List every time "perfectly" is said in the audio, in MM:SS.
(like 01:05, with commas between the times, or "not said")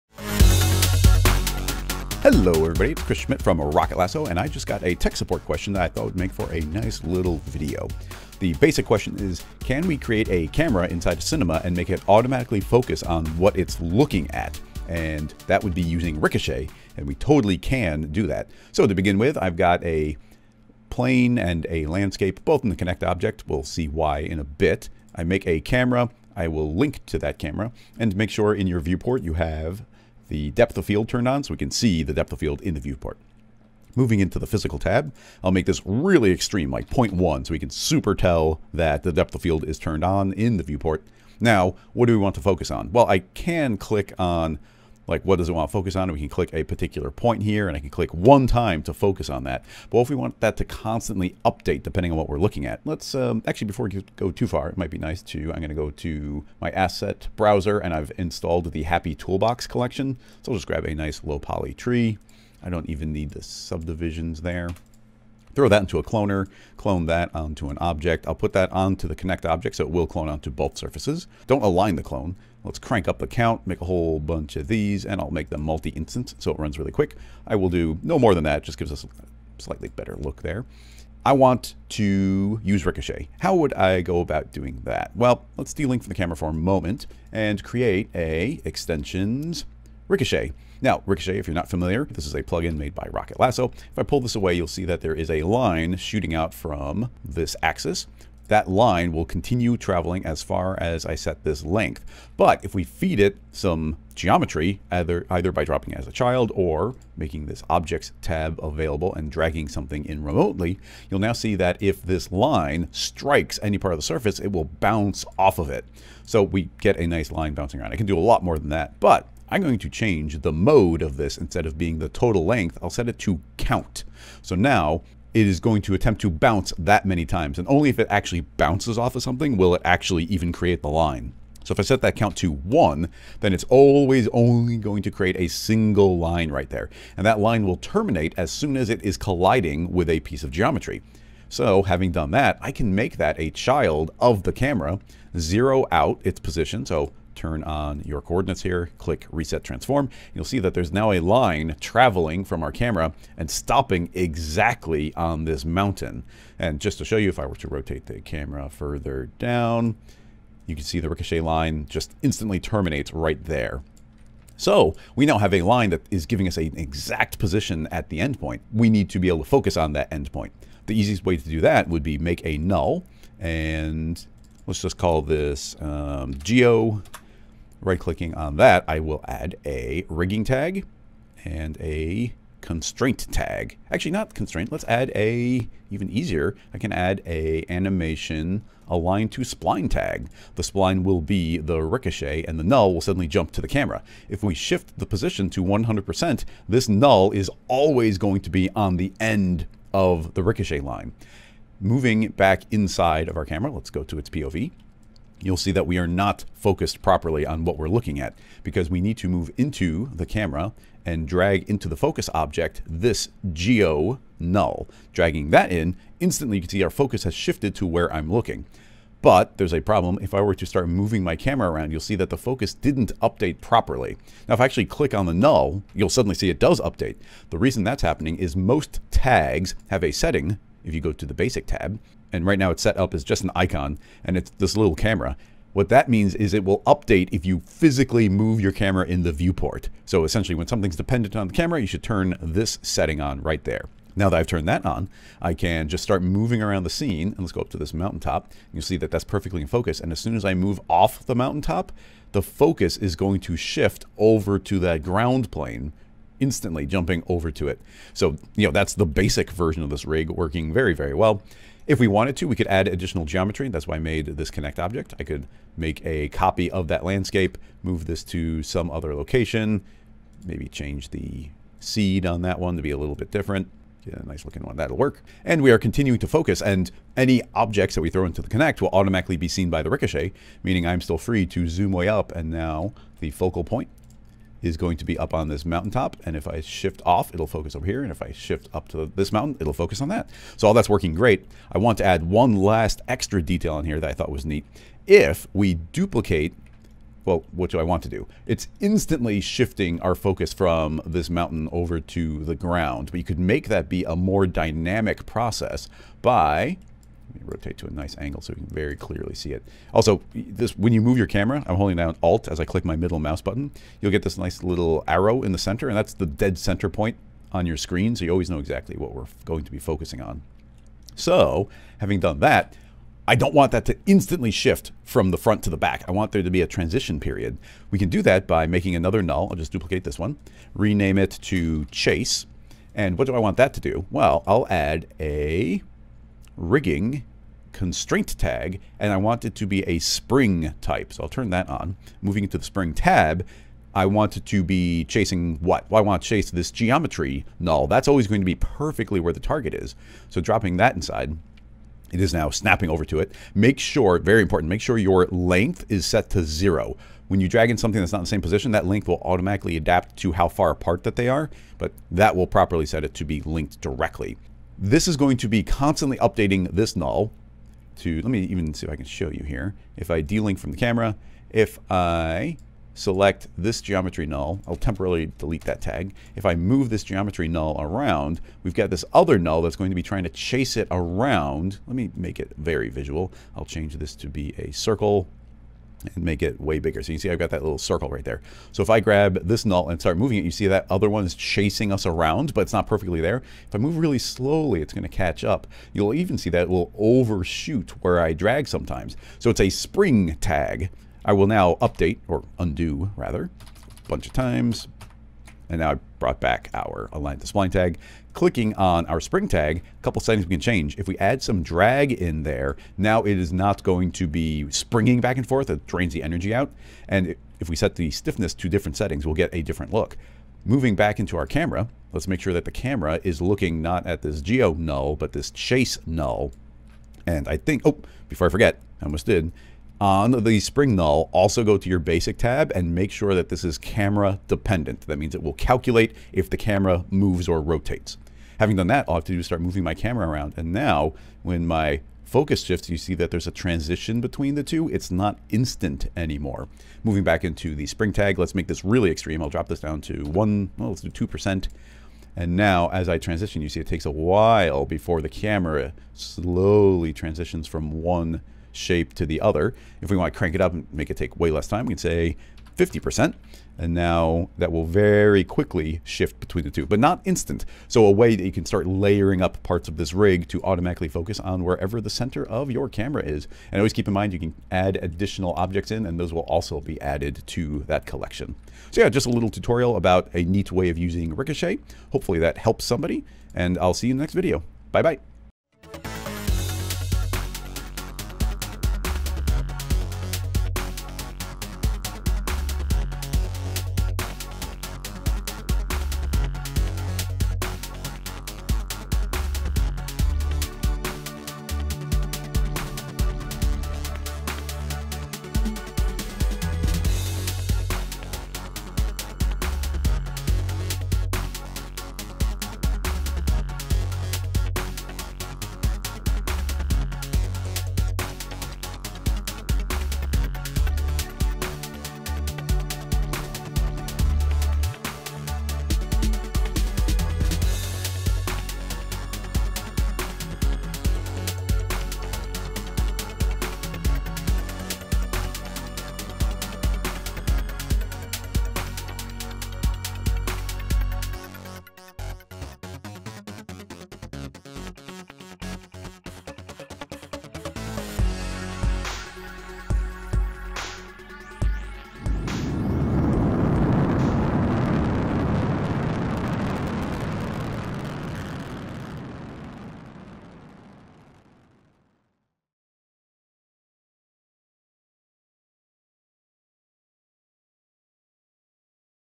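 04:09, 05:48, 06:32.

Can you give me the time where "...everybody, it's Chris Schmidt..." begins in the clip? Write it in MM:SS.
00:02.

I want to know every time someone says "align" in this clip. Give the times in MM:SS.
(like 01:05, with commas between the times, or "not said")
01:11, 03:08, 06:47.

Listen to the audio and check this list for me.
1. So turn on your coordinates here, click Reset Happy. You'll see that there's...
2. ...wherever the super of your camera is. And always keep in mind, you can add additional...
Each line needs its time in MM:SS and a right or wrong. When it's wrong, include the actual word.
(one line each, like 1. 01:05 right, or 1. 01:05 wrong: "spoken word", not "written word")
1. 02:26 wrong: "Transform", not "Happy"
2. 07:51 wrong: "center", not "super".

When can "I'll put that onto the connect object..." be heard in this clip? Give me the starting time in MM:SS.
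01:08.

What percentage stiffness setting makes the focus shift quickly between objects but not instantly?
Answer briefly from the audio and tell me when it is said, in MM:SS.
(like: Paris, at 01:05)
50%, at 07:42.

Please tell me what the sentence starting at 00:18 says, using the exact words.
So to begin with, I've got a plane and a landscape, both in the Connect object.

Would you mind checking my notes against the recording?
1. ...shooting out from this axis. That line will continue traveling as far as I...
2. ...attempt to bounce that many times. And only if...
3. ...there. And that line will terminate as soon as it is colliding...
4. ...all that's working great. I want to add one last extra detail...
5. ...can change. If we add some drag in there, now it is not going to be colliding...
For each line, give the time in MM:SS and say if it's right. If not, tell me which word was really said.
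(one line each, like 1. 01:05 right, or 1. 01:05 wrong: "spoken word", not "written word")
1. 01:35 right
2. 02:05 right
3. 02:16 right
4. 04:50 right
5. 06:50 wrong: "springing", not "colliding".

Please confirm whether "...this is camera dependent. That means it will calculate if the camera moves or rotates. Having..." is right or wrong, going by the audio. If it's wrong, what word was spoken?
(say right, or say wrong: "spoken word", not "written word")
right.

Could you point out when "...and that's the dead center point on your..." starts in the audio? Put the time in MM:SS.
05:15.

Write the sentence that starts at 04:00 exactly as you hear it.
So essentially when something's dependent on the camera, you should turn this setting on right there.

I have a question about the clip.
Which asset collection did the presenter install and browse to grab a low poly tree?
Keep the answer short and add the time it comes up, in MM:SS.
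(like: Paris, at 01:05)
Happy Toolbox, at 00:58.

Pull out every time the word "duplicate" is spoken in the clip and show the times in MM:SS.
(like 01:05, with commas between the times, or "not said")
04:55, 05:29.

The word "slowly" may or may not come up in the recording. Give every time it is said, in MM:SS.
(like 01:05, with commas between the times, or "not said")
06:34, 07:36.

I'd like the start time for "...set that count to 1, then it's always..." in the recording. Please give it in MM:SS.
02:11.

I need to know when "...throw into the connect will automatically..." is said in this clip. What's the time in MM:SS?
04:38.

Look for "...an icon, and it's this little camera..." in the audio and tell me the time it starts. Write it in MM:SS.
03:53.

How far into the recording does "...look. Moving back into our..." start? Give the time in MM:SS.
06:59.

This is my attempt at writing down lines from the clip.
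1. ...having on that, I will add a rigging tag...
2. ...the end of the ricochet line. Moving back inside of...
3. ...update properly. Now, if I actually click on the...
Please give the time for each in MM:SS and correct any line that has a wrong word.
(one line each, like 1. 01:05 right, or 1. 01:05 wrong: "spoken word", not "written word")
1. 02:57 wrong: "clicking", not "having"
2. 03:18 right
3. 03:43 right.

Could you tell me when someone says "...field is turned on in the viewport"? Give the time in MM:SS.
00:39.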